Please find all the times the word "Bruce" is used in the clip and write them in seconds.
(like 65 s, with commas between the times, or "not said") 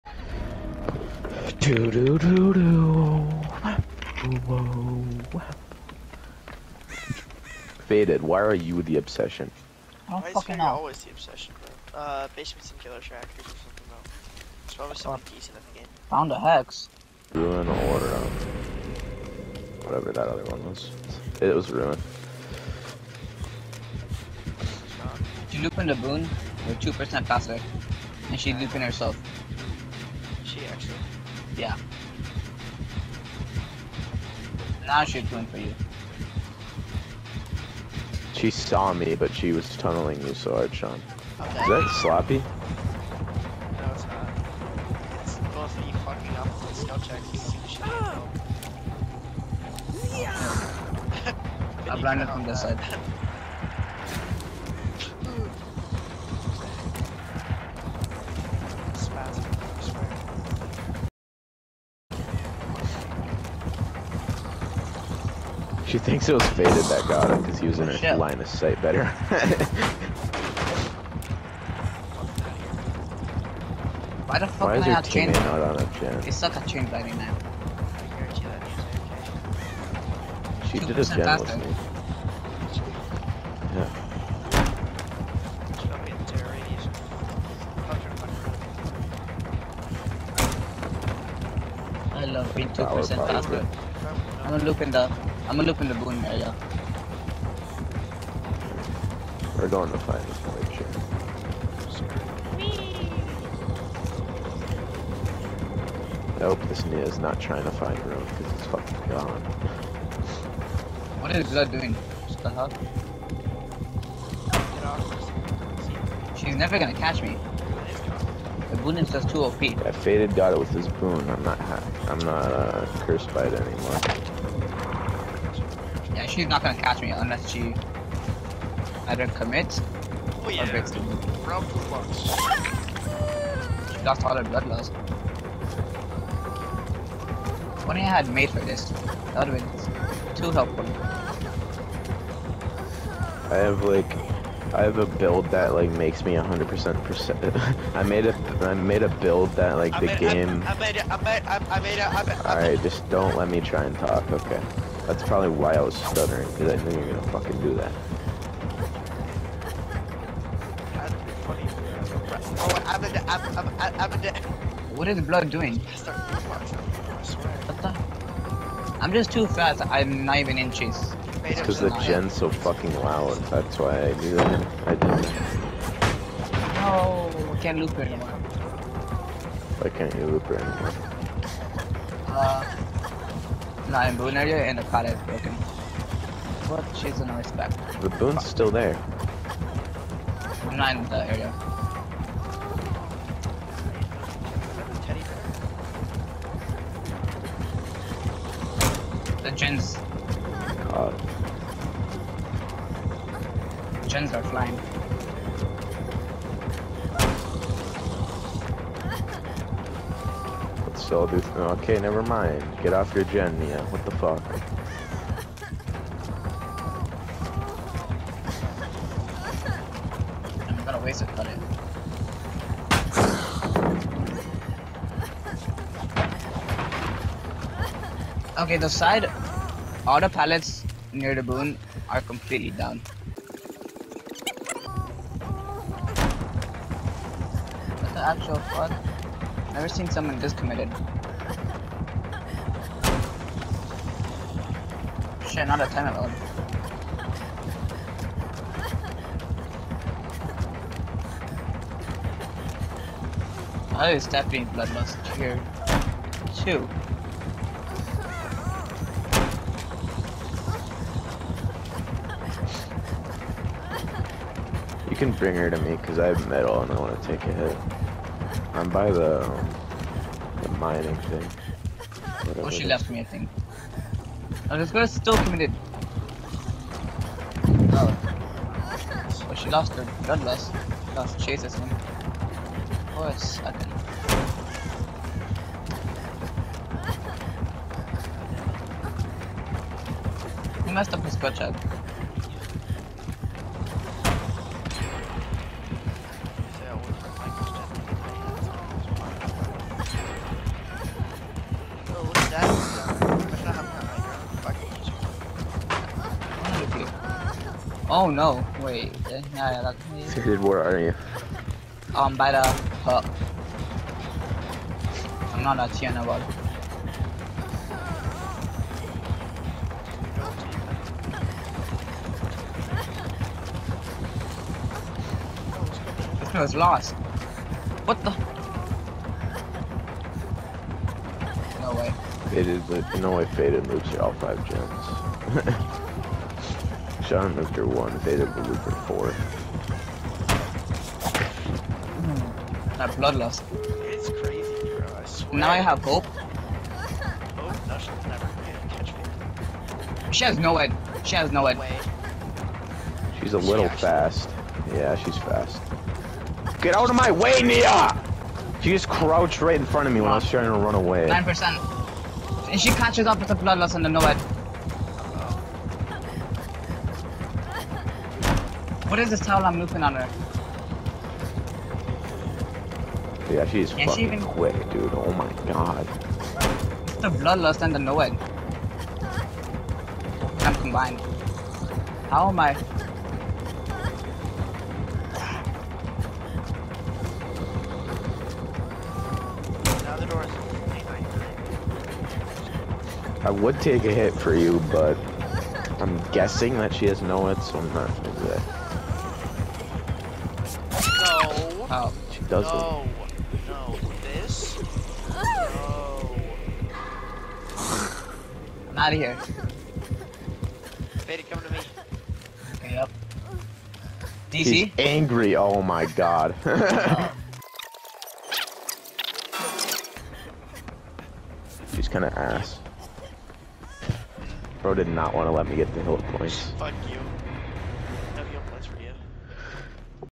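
not said.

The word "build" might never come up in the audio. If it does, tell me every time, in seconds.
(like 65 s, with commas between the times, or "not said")
145 s, 149 s.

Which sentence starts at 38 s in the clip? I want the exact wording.
She saw me, but she was tunneling you so hard, Sean.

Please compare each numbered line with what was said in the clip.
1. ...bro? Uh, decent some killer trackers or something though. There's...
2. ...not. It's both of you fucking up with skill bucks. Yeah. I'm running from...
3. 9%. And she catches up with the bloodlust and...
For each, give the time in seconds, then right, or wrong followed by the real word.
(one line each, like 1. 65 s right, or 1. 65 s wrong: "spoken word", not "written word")
1. 11 s wrong: "basement", not "decent"
2. 44 s wrong: "checks", not "bucks"
3. 361 s right.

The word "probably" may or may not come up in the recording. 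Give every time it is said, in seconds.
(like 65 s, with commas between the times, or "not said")
14 s, 155 s.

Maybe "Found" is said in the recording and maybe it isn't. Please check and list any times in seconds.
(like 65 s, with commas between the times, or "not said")
16 s.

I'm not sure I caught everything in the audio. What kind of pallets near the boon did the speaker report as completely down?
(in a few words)
side auto pallets.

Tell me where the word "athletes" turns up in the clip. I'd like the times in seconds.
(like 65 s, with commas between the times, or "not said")
not said.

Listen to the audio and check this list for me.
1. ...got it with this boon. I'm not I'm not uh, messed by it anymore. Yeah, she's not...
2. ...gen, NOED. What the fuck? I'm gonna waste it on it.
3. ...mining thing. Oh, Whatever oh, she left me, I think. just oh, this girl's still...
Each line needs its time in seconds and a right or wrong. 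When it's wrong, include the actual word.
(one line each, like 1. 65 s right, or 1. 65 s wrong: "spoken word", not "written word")
1. 120 s wrong: "cursed", not "messed"
2. 213 s wrong: "Mia", not "NOED"
3. 270 s right.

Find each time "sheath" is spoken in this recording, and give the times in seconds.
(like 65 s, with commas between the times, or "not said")
not said.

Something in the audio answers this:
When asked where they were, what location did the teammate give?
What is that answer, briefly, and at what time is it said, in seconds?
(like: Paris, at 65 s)
by the hub, at 312 s.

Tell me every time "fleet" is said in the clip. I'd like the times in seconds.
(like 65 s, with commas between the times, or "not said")
not said.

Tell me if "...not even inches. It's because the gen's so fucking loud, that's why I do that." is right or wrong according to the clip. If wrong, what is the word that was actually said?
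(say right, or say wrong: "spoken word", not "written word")
right.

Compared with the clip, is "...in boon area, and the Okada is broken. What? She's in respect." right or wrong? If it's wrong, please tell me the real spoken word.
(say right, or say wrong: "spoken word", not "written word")
right.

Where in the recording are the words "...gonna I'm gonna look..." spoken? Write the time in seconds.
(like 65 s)
94 s.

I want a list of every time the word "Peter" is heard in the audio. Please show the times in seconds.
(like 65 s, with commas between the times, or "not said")
not said.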